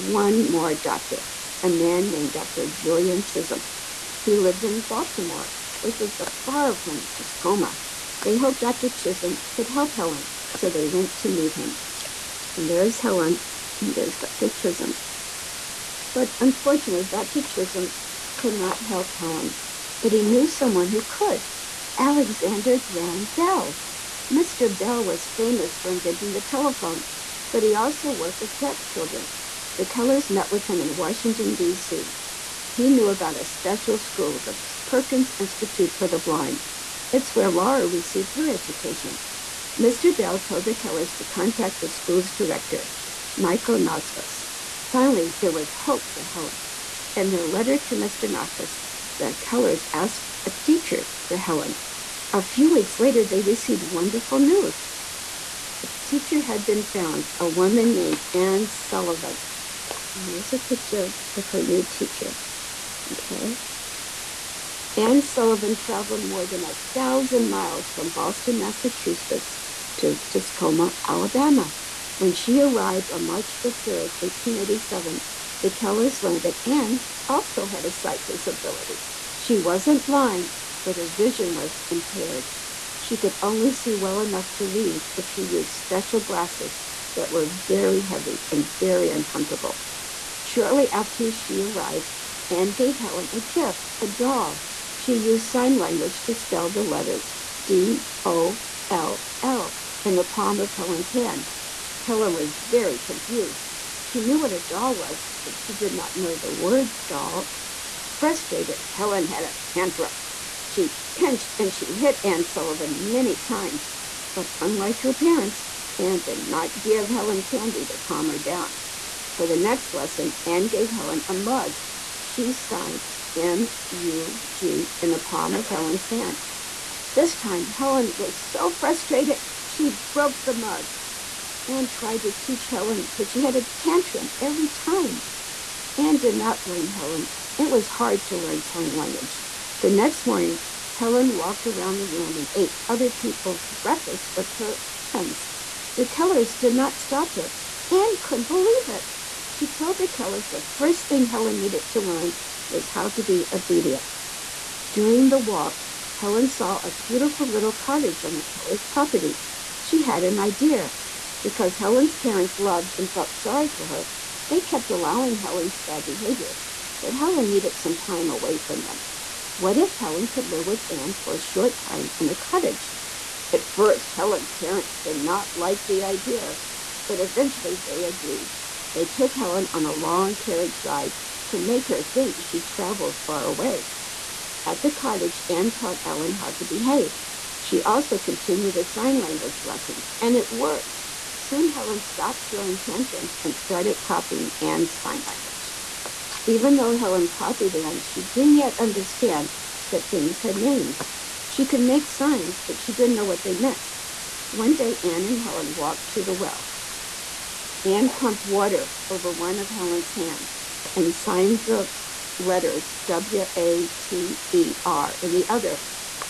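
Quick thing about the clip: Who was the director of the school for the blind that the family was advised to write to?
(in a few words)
Michael Noskos.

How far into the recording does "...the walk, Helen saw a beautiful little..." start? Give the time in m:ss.
2:35.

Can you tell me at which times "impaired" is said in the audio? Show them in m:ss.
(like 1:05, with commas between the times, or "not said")
1:21.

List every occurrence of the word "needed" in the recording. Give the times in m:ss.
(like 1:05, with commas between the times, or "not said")
2:31, 2:47.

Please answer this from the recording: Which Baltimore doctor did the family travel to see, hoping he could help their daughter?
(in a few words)
Dr. Julian Chisolm.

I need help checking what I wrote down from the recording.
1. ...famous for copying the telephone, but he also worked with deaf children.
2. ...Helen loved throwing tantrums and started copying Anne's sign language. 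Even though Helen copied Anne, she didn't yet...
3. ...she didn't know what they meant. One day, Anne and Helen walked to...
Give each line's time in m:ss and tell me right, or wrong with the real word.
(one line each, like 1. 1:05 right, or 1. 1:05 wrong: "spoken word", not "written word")
1. 0:25 wrong: "inventing", not "copying"
2. 3:11 wrong: "stopped", not "loved"
3. 3:22 right.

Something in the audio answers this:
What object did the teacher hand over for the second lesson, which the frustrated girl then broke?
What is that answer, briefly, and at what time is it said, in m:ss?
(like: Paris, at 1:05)
A mug, at 2:01.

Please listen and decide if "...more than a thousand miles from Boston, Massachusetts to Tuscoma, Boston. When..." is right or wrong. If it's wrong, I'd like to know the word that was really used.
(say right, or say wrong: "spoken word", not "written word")
wrong: "Alabama", not "Boston".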